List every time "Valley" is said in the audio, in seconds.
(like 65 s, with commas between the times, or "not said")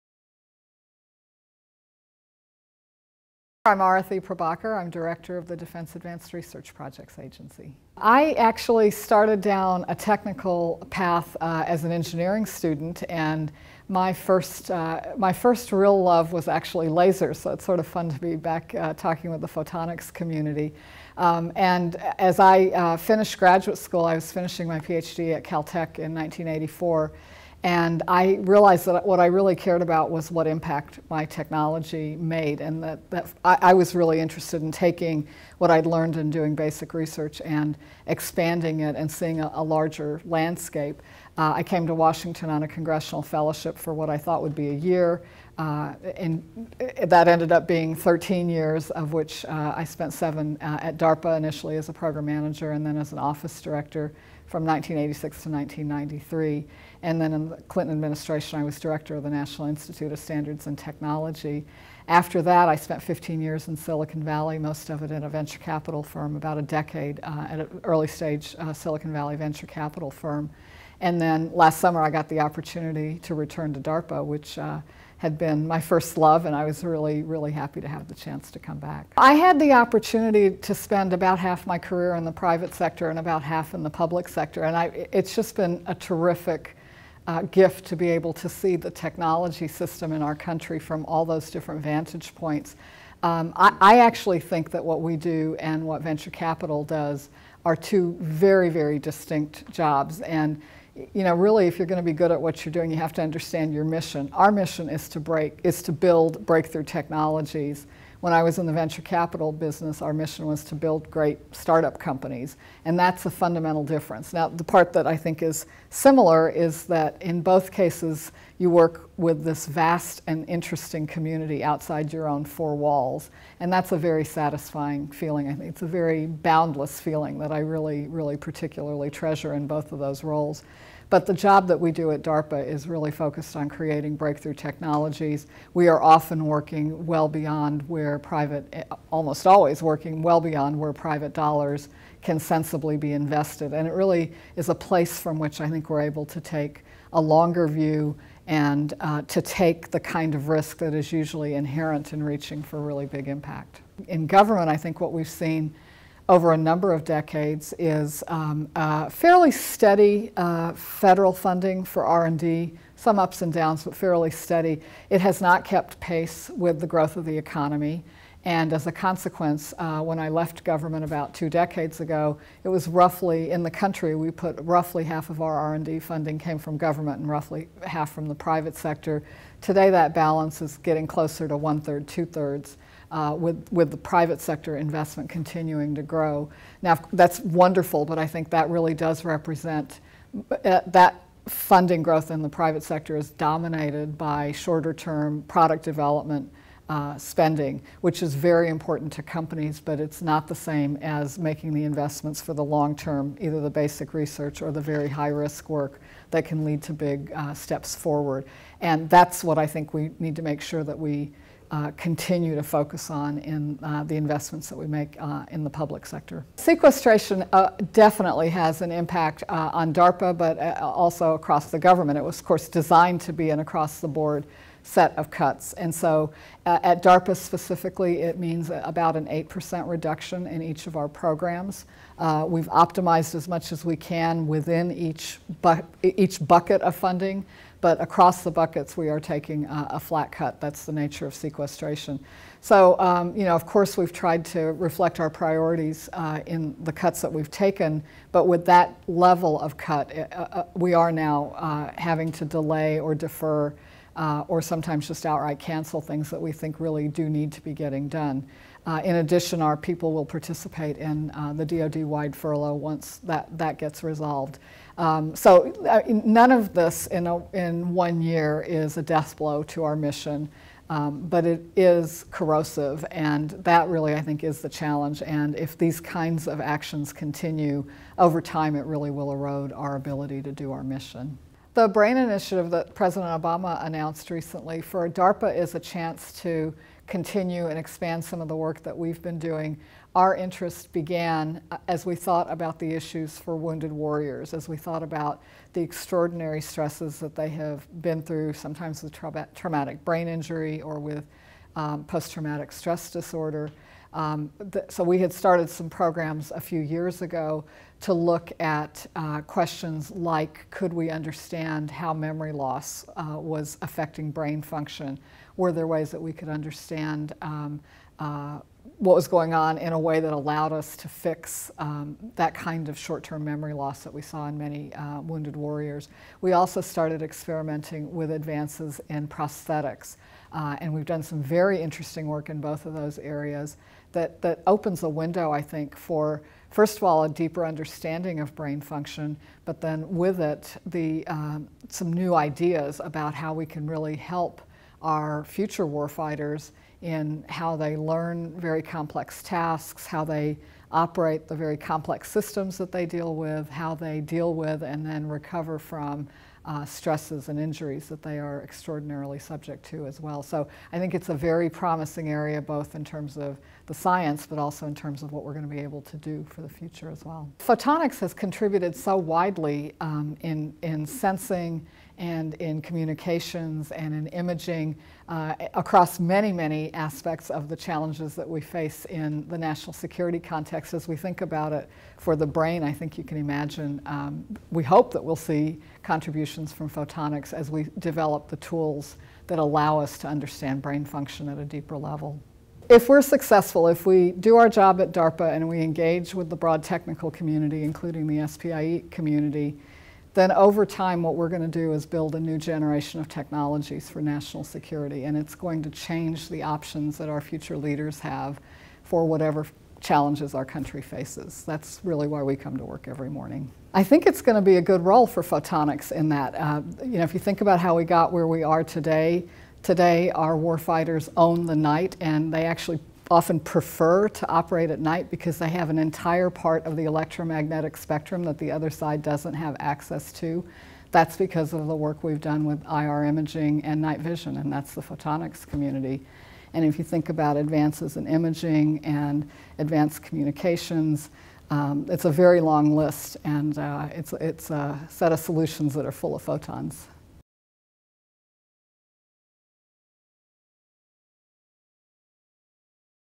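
64 s, 69 s.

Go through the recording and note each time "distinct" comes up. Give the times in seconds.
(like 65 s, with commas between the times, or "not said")
98 s.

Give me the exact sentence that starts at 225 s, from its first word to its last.
And so at DARPA specifically, it means about an 8% reduction in each of our programs.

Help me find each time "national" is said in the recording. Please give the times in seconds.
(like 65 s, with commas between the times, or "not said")
59 s, 379 s, 404 s.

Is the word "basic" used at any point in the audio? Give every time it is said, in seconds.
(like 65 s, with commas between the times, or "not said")
36 s, 203 s.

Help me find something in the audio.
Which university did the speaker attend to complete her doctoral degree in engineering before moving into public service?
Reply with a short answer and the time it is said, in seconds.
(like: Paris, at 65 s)
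Caltech, at 25 s.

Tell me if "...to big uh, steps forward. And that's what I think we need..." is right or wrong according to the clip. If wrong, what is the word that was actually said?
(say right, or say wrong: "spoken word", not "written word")
right.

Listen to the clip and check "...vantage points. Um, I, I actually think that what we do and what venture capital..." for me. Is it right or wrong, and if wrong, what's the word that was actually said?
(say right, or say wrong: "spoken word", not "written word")
right.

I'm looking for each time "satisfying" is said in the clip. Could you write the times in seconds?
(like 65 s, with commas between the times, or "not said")
124 s.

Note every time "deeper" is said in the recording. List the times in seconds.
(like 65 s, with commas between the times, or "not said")
337 s, 391 s.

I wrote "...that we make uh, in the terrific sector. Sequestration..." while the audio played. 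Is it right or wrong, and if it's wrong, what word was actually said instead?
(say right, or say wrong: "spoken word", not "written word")
wrong: "public", not "terrific".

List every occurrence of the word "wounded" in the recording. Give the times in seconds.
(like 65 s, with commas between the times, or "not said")
293 s, 325 s.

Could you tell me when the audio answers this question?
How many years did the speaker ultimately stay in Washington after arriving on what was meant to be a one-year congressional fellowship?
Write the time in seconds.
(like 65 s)
47 s.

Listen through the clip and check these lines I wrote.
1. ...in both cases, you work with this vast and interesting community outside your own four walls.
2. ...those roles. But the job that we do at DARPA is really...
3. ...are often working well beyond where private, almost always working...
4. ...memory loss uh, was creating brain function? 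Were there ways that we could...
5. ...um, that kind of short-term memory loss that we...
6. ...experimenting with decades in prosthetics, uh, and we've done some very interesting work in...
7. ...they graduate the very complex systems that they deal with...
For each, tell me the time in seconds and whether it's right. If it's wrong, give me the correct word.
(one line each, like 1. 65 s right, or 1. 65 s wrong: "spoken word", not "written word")
1. 117 s right
2. 129 s right
3. 135 s right
4. 312 s wrong: "affecting", not "creating"
5. 321 s right
6. 327 s wrong: "advances", not "decades"
7. 350 s wrong: "operate", not "graduate".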